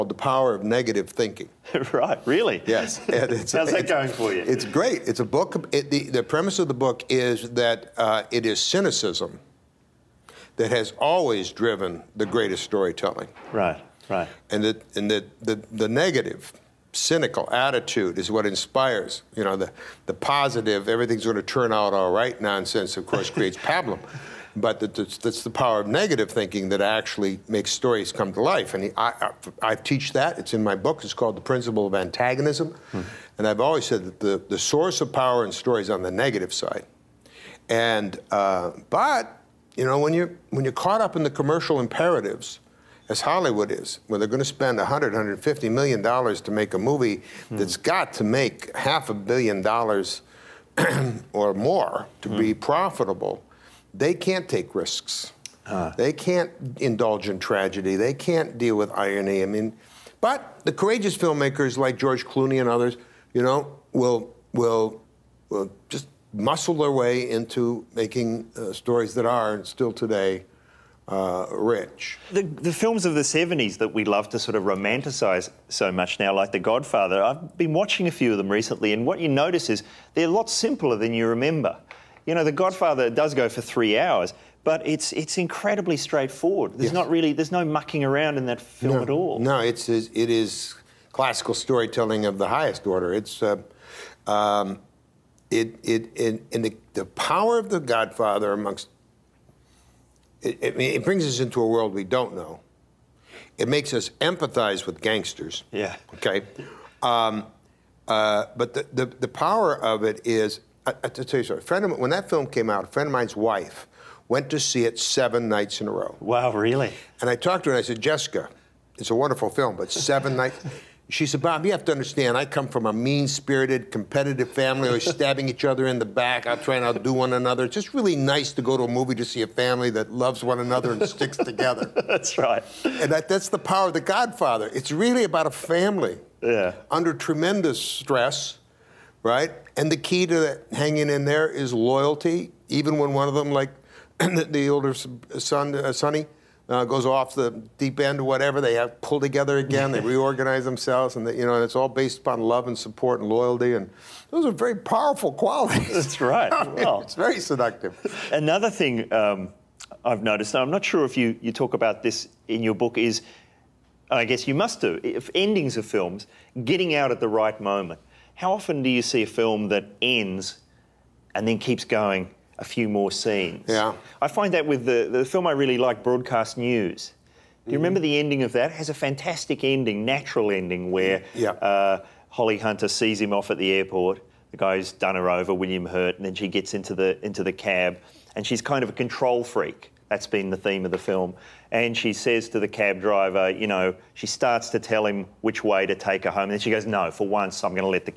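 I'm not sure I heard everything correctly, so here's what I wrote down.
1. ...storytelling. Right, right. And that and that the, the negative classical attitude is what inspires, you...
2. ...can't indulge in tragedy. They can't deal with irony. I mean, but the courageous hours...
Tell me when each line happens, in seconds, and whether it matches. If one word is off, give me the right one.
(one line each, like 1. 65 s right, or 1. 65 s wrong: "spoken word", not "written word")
1. 12 s wrong: "cynical", not "classical"
2. 56 s wrong: "filmmakers", not "hours".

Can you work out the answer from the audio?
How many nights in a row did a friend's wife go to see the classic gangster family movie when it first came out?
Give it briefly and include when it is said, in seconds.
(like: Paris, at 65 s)
7, at 114 s.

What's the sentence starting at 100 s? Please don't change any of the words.
It, it, it brings us into a world we don't know.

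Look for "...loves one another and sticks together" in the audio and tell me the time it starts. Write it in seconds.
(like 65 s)
130 s.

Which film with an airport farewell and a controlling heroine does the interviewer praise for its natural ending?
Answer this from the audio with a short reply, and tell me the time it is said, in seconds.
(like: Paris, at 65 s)
Broadcast News, at 176 s.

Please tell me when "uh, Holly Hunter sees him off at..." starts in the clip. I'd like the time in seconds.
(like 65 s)
181 s.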